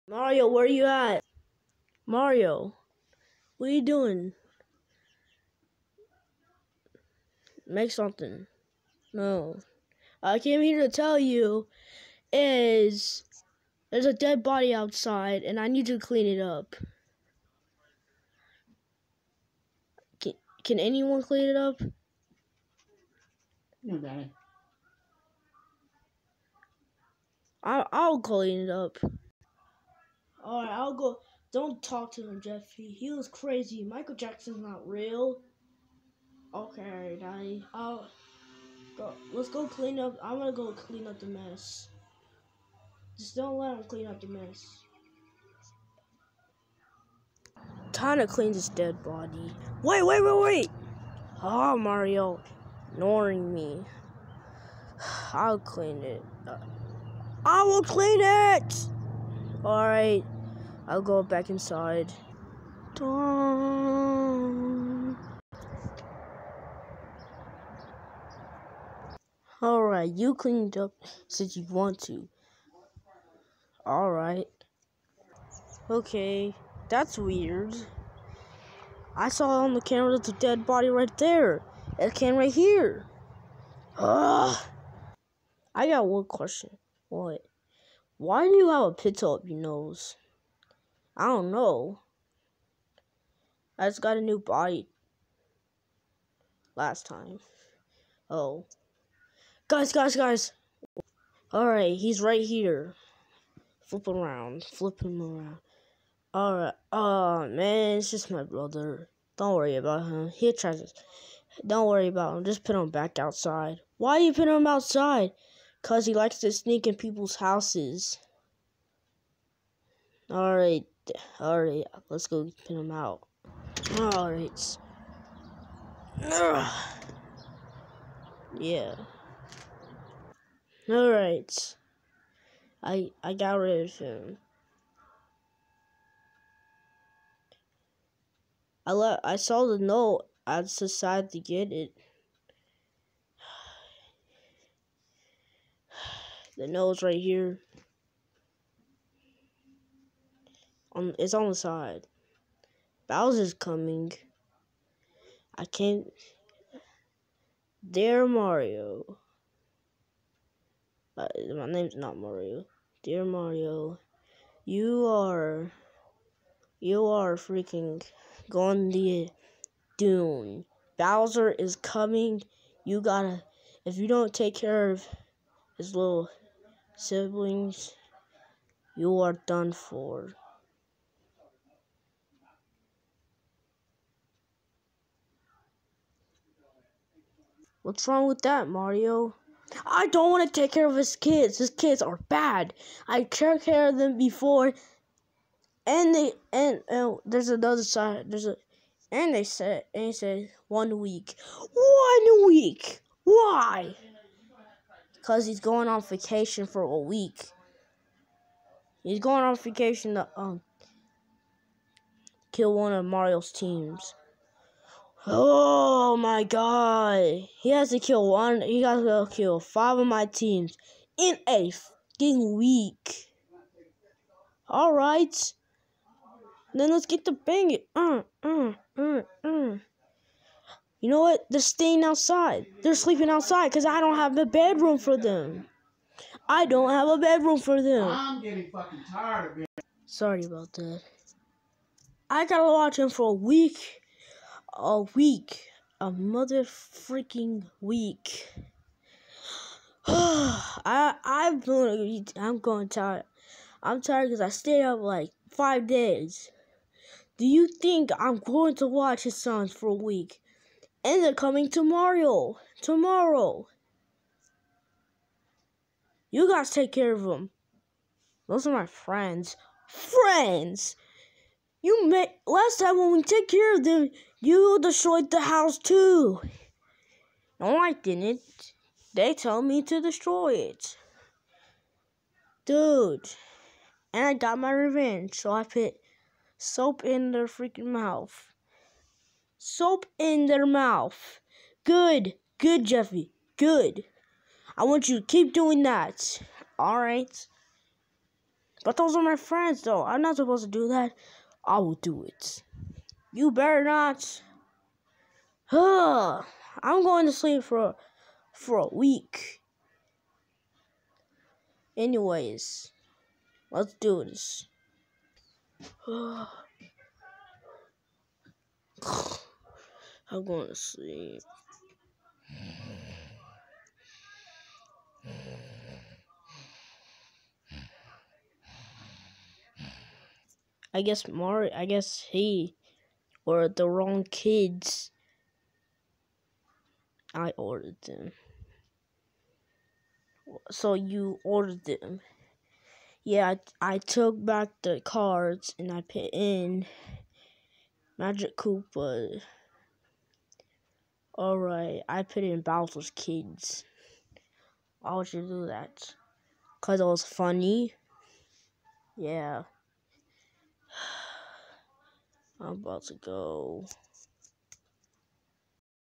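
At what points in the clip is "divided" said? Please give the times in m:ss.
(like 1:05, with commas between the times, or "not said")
not said.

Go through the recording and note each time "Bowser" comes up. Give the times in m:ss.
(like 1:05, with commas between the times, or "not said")
2:33, 2:50, 5:52.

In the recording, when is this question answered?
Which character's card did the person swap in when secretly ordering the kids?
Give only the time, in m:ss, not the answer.
5:48.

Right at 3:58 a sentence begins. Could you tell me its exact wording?
I'm getting fucking tired of it.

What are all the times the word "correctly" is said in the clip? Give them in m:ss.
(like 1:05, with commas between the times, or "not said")
not said.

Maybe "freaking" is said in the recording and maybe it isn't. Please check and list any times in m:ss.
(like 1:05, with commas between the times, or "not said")
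2:47, 4:06, 4:47.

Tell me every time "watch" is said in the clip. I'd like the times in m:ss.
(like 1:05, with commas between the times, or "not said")
4:02, 4:18.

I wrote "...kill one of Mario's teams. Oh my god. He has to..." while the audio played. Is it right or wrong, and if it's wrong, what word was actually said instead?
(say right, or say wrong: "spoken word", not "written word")
right.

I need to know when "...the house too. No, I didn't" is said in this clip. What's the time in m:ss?
4:35.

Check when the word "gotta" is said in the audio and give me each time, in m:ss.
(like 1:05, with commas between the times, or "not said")
2:53, 4:02.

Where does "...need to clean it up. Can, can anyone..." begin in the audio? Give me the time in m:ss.
0:15.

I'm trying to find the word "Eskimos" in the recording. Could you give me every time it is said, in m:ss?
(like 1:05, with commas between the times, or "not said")
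not said.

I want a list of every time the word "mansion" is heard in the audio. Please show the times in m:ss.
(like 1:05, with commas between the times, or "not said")
not said.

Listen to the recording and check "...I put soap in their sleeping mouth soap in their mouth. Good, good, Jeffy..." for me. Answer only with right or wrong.
wrong.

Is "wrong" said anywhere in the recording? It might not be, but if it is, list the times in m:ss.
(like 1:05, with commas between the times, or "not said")
3:08, 5:33.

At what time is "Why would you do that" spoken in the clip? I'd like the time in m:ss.
5:54.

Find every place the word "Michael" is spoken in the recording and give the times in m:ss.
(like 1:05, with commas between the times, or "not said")
0:33.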